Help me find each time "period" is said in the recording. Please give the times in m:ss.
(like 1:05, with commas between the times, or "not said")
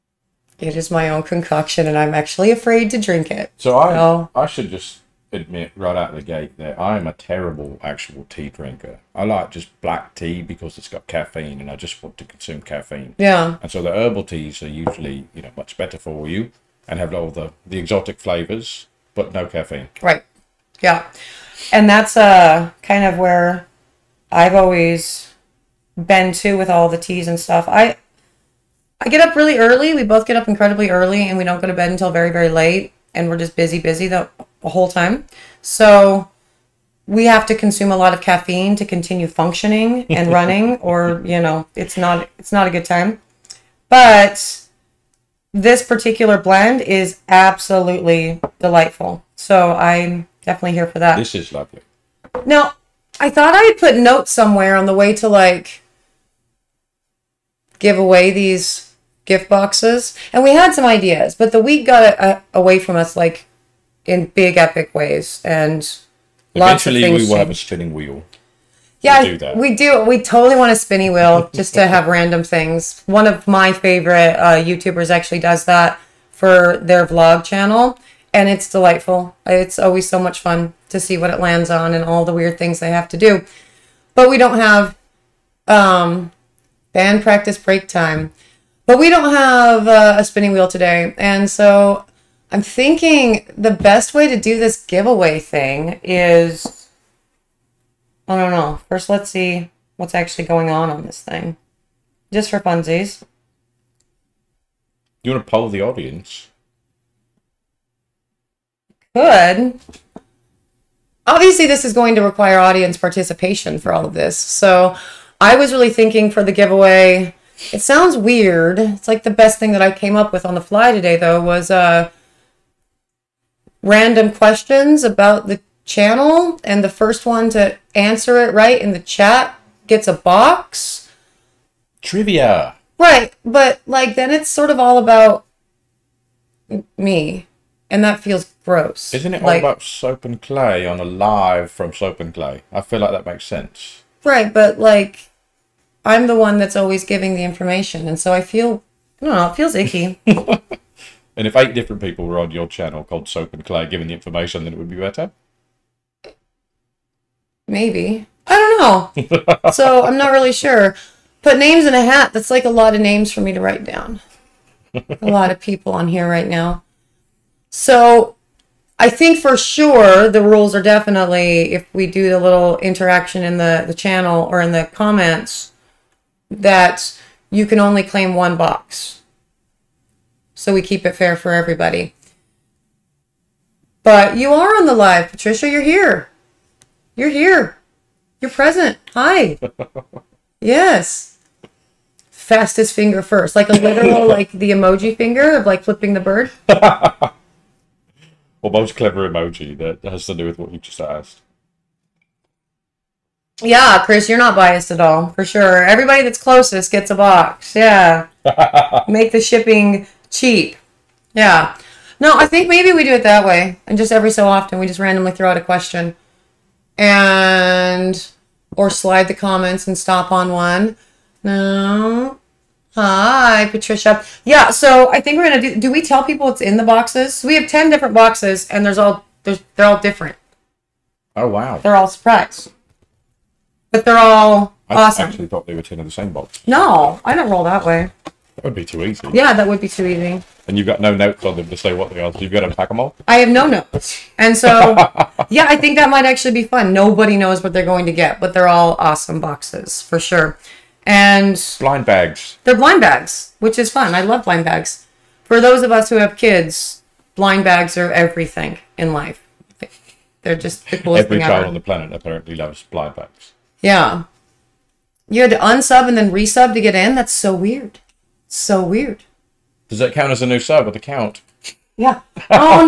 not said.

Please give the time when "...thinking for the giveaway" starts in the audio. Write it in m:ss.
1:55.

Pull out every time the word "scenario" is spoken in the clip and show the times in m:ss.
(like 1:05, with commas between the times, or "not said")
not said.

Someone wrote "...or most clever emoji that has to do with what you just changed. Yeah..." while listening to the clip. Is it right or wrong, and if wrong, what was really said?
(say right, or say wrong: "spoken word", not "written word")
wrong: "asked", not "changed".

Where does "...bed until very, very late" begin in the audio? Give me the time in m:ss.
0:31.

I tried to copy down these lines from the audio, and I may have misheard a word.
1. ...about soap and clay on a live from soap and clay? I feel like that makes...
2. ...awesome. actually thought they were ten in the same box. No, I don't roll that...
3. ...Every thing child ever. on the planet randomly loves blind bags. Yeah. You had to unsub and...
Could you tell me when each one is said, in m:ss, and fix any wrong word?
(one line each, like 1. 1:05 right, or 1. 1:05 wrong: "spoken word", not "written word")
1. 2:19 right
2. 3:54 right
3. 4:21 wrong: "apparently", not "randomly".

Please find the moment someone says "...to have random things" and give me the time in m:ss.
1:11.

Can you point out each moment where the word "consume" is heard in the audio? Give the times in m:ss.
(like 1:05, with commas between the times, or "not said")
0:12, 0:37.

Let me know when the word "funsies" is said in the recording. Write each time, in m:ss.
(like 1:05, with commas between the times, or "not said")
1:42.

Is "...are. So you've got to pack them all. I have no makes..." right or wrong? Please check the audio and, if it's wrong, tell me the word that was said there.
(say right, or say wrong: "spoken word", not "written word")
wrong: "notes", not "makes".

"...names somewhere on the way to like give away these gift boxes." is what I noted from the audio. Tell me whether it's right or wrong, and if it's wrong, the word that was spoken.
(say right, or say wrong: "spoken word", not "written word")
wrong: "notes", not "names".